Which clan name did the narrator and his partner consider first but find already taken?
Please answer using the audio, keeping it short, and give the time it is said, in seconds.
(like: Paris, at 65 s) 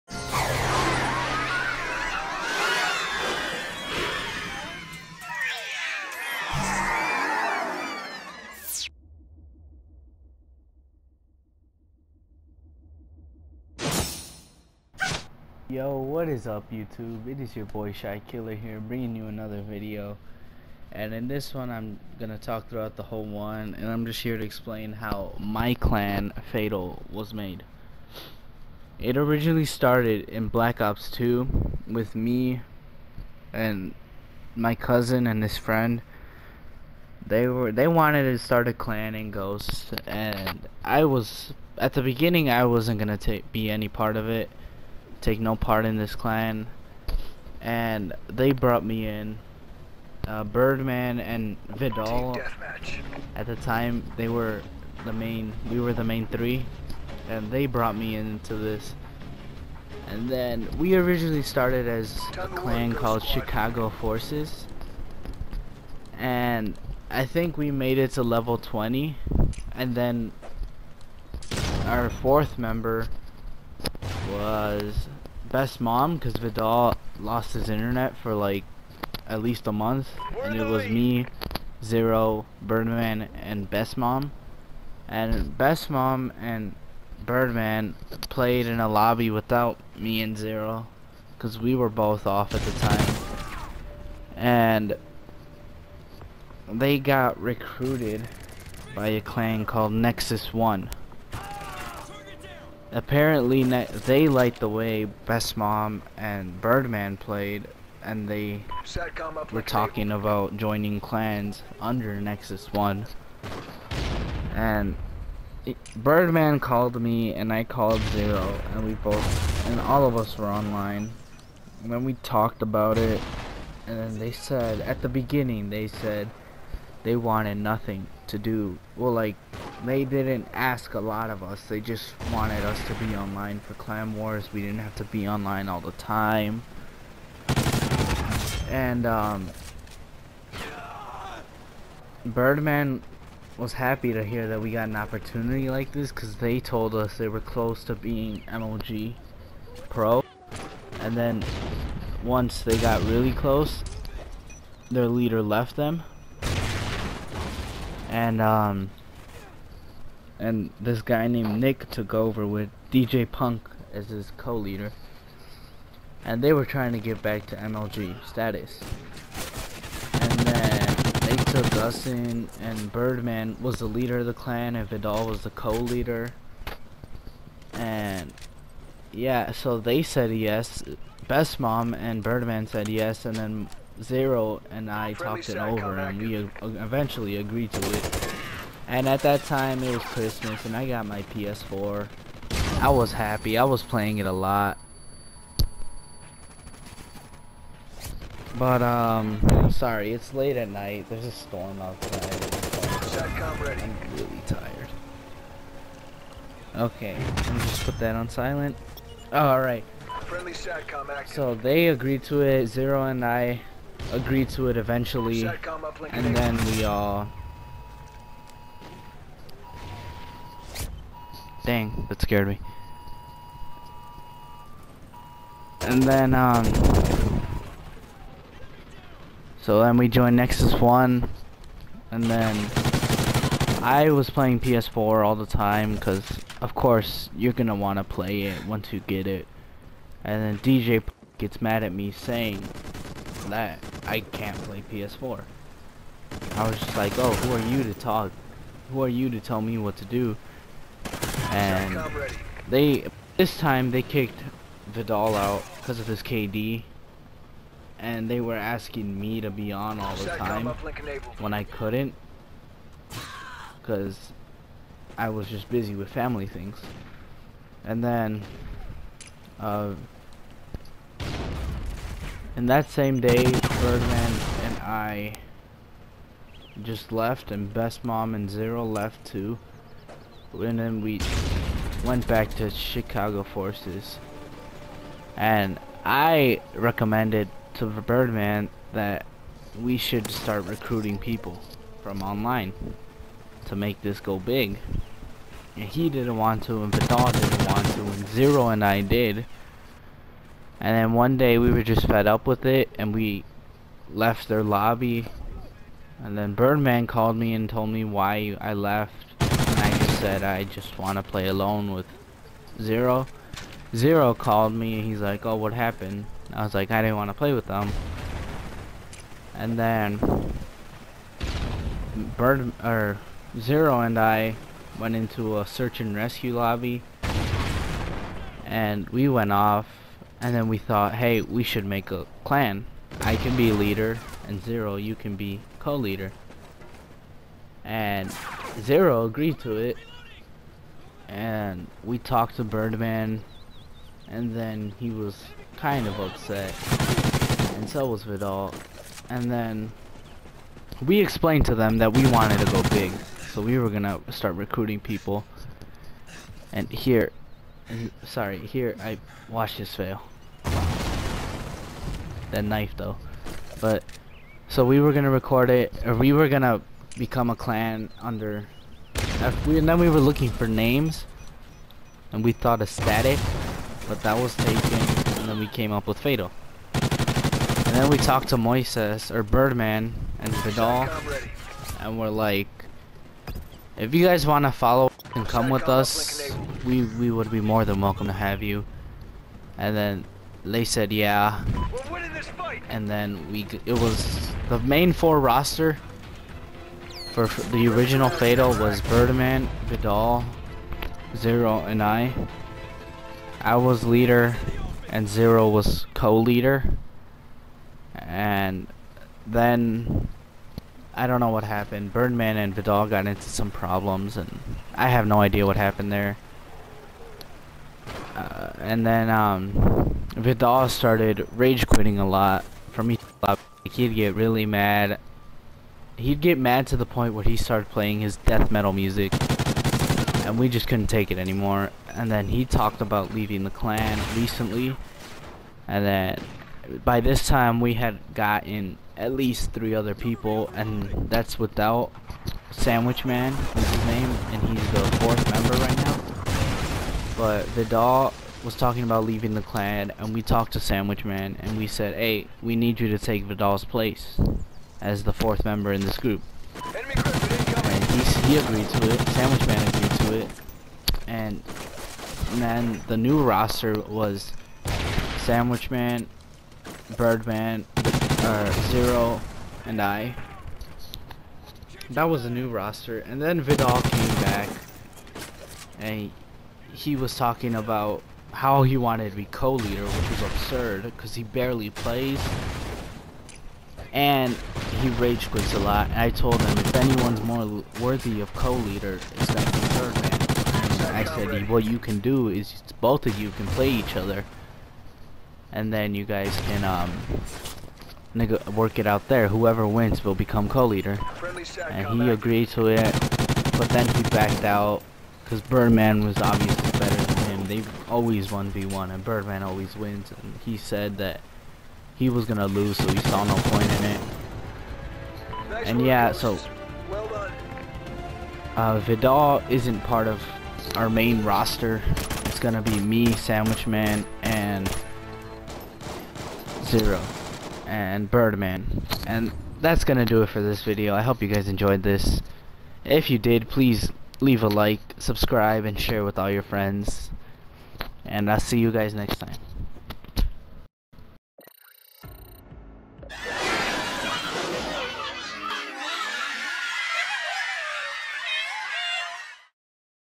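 Static, at 372 s.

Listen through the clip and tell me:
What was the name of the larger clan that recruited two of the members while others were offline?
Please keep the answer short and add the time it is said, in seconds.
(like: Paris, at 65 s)
Nexus One, at 99 s.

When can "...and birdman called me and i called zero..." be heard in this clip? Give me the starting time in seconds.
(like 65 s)
114 s.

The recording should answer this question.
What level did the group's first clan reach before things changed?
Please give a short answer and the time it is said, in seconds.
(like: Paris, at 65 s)
20, at 68 s.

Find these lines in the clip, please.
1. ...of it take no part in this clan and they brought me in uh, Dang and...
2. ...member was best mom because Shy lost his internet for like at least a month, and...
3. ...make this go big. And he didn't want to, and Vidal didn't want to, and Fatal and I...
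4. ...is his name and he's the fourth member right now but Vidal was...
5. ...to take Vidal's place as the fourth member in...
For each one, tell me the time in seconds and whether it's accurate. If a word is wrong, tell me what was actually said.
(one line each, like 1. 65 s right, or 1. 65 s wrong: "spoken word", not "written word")
1. 44 s wrong: "Birdman", not "Dang"
2. 72 s wrong: "Vidal", not "Shy"
3. 293 s wrong: "Zero", not "Fatal"
4. 443 s right
5. 453 s right.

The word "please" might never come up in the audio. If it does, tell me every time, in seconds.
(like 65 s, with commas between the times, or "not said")
533 s.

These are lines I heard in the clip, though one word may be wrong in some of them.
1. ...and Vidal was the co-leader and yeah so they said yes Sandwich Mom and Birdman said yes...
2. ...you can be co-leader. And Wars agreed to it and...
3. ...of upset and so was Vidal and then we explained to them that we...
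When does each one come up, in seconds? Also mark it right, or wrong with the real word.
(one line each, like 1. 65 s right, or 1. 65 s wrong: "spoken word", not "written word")
1. 174 s wrong: "Best", not "Sandwich"
2. 334 s wrong: "Zero", not "Wars"
3. 346 s right.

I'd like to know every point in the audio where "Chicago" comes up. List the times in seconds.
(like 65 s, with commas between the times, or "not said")
63 s, 282 s.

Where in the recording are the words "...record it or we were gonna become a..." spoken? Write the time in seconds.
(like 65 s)
365 s.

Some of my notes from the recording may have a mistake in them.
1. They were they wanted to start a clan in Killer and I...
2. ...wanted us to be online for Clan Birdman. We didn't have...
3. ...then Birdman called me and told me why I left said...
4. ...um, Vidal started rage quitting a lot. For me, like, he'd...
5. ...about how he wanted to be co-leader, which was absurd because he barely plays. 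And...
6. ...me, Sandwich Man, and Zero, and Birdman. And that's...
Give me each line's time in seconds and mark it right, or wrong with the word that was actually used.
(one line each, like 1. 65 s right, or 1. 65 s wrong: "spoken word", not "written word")
1. 37 s wrong: "Ghosts", not "Killer"
2. 132 s wrong: "Wars", not "Birdman"
3. 306 s right
4. 419 s right
5. 477 s right
6. 522 s right.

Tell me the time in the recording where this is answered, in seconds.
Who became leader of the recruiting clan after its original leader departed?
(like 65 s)
161 s.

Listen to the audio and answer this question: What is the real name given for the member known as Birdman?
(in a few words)
Moises.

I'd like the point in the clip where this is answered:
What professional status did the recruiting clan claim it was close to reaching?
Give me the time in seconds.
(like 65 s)
148 s.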